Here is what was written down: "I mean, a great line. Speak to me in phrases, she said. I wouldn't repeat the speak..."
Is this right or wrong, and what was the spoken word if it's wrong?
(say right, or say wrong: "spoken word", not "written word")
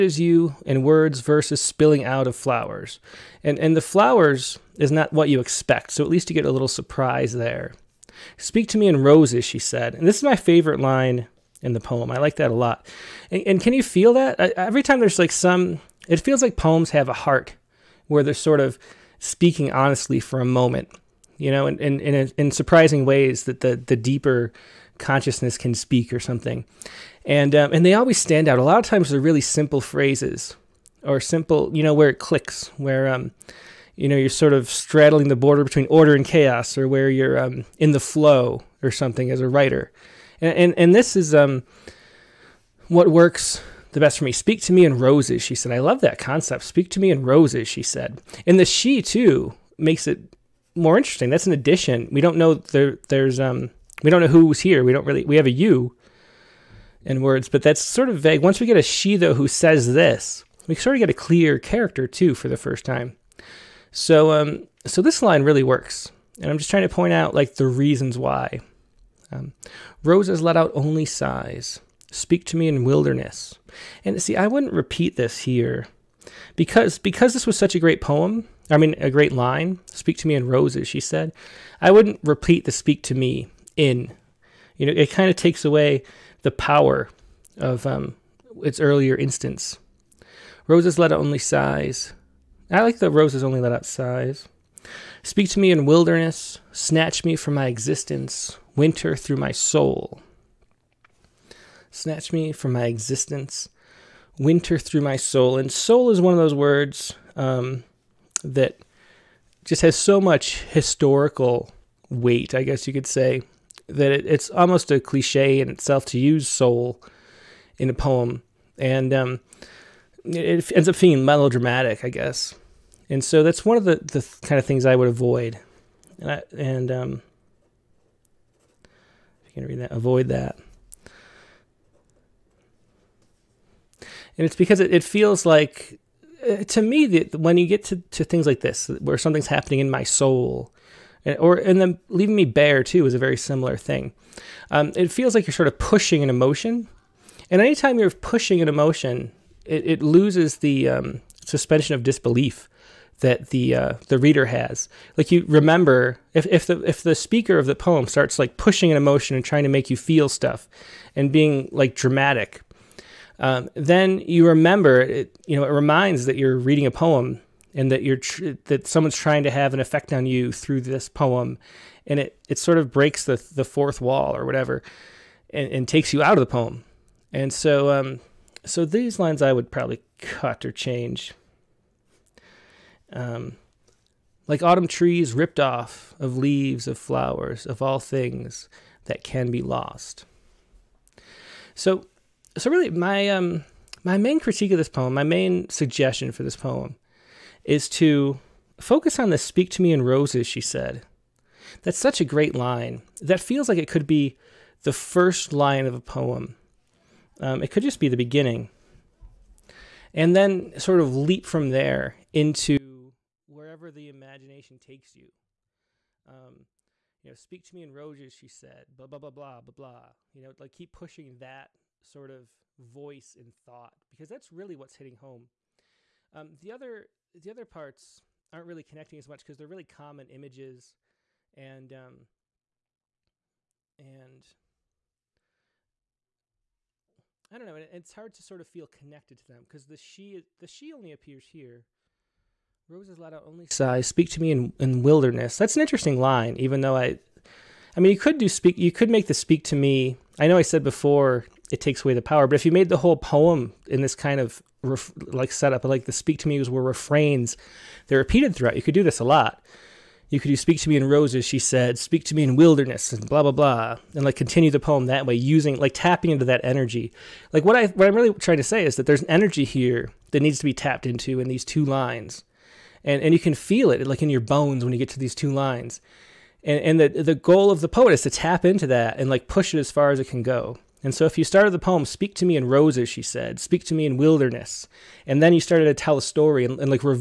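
wrong: "roses", not "phrases".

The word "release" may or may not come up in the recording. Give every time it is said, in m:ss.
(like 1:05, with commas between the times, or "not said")
not said.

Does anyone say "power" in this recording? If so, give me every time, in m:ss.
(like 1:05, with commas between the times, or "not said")
1:26, 4:12.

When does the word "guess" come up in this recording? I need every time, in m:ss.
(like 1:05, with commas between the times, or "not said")
1:52, 2:02.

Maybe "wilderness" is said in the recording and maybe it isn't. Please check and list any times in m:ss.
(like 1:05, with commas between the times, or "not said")
1:12, 1:35, 4:05, 4:22, 4:44.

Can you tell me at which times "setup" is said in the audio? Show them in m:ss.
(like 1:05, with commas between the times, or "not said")
4:15.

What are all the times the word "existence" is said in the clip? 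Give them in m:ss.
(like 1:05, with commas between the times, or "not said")
1:37, 1:42.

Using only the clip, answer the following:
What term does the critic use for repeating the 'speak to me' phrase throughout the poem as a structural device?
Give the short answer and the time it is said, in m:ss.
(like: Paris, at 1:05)
refrains, at 4:16.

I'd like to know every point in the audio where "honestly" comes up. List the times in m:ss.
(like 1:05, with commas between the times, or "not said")
0:19.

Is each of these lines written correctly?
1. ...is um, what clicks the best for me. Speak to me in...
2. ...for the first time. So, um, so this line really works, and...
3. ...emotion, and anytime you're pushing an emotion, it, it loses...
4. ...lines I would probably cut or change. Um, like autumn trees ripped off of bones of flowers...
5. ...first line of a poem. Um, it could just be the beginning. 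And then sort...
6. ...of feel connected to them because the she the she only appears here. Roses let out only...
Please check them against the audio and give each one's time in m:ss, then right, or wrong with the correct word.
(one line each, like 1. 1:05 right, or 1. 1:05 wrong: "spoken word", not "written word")
1. 0:41 wrong: "works", not "clicks"
2. 1:02 right
3. 2:26 right
4. 2:59 wrong: "leaves", not "bones"
5. 3:24 right
6. 3:58 right.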